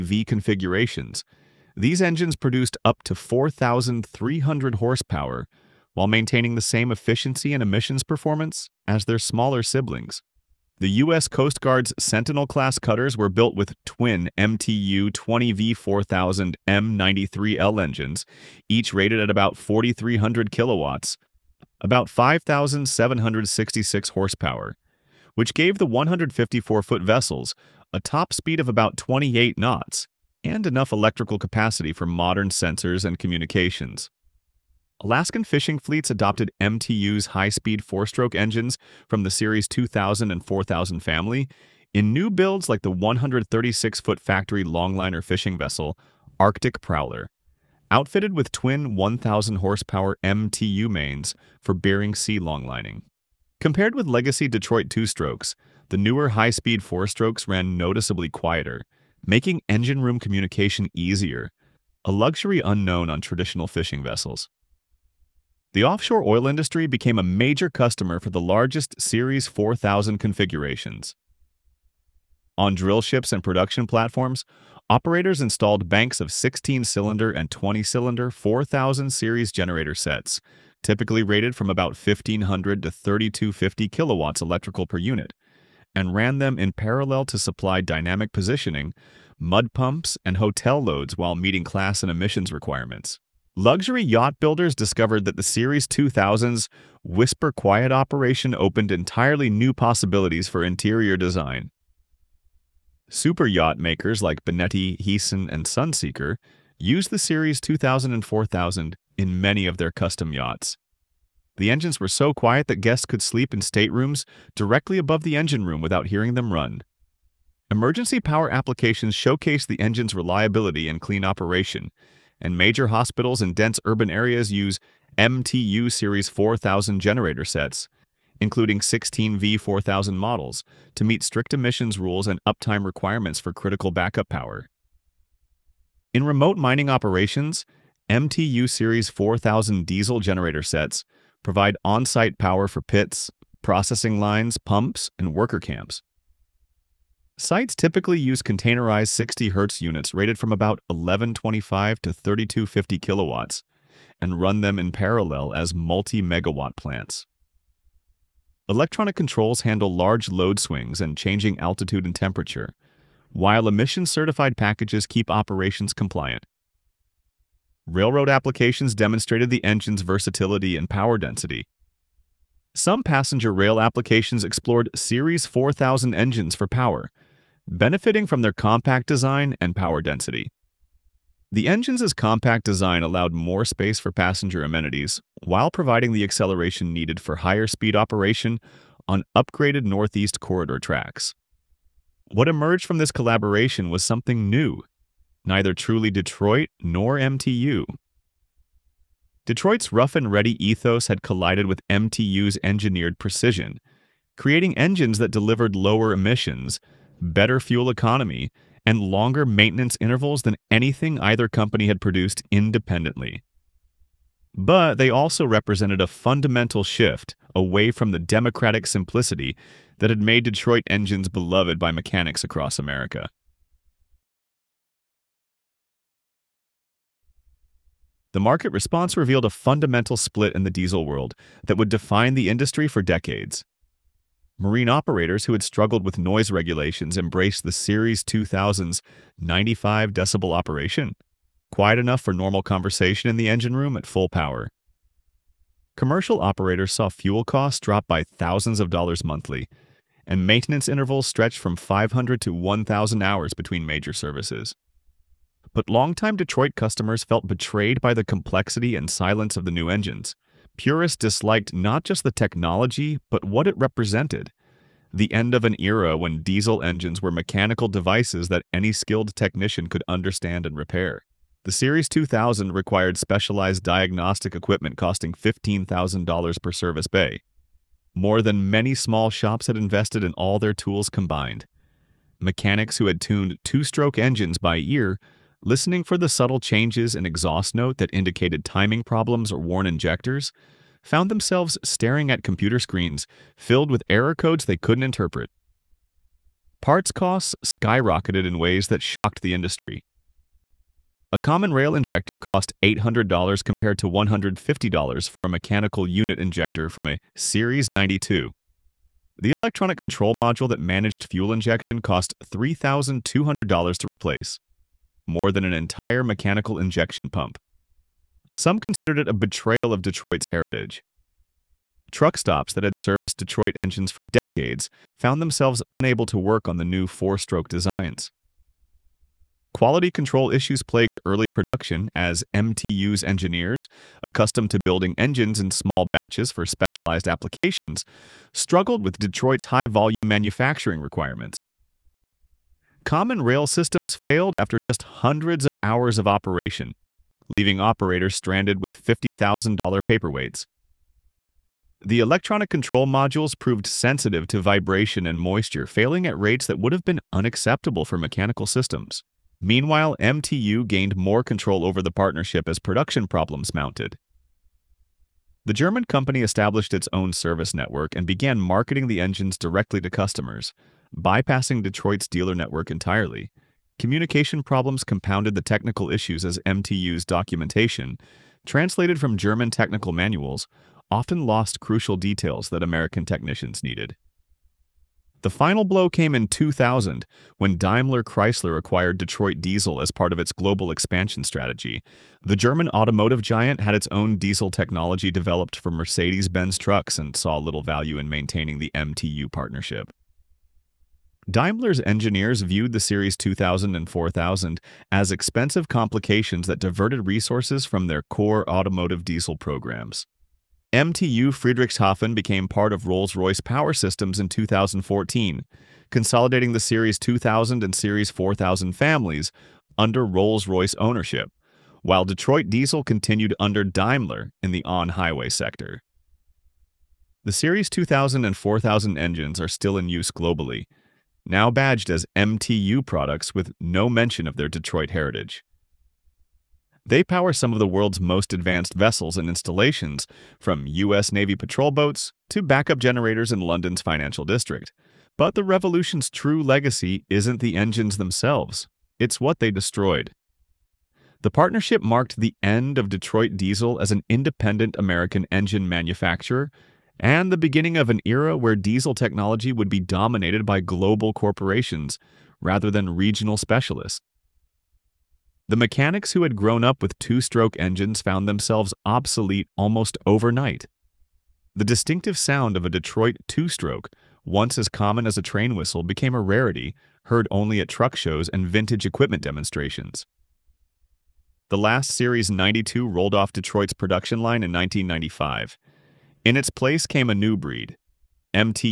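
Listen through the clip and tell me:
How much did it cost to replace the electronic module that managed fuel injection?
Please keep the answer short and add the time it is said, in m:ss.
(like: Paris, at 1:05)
$3,200, at 5:12.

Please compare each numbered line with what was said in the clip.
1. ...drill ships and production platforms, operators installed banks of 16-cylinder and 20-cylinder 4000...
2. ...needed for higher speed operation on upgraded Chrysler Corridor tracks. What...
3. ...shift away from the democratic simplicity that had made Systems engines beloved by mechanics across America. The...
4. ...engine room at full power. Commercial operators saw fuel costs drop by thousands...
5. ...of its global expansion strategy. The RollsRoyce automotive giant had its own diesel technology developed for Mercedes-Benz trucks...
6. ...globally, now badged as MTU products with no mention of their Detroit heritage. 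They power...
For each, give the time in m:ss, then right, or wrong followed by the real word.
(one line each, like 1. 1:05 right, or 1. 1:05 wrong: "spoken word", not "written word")
1. 1:12 right
2. 3:06 wrong: "Northeast", not "Chrysler"
3. 3:36 wrong: "Detroit", not "Systems"
4. 4:03 right
5. 6:30 wrong: "German", not "RollsRoyce"
6. 7:10 right.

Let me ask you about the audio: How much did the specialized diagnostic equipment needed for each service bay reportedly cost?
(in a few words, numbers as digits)
$15,000.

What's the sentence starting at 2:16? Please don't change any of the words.
In remote mining operations, MTU Series 4000 diesel generator sets provide on-site power for pits, processing lines, pumps, and worker camps.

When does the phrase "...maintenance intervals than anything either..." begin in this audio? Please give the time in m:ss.
3:29.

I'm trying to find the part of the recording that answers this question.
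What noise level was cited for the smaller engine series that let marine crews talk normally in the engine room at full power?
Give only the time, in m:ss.
3:59.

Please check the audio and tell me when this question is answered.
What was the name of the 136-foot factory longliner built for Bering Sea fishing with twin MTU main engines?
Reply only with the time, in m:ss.
0:46.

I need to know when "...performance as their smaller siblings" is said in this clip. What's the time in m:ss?
0:08.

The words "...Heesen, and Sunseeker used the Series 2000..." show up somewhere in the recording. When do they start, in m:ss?
1:45.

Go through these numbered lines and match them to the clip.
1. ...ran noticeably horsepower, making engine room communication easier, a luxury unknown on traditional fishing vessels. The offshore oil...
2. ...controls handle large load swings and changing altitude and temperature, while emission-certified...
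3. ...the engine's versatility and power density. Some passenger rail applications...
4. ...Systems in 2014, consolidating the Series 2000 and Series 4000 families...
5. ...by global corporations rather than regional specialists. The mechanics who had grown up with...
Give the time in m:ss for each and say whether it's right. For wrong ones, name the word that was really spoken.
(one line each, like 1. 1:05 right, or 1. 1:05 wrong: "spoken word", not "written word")
1. 0:57 wrong: "quieter", not "horsepower"
2. 2:39 right
3. 2:49 right
4. 6:53 right
5. 7:40 right.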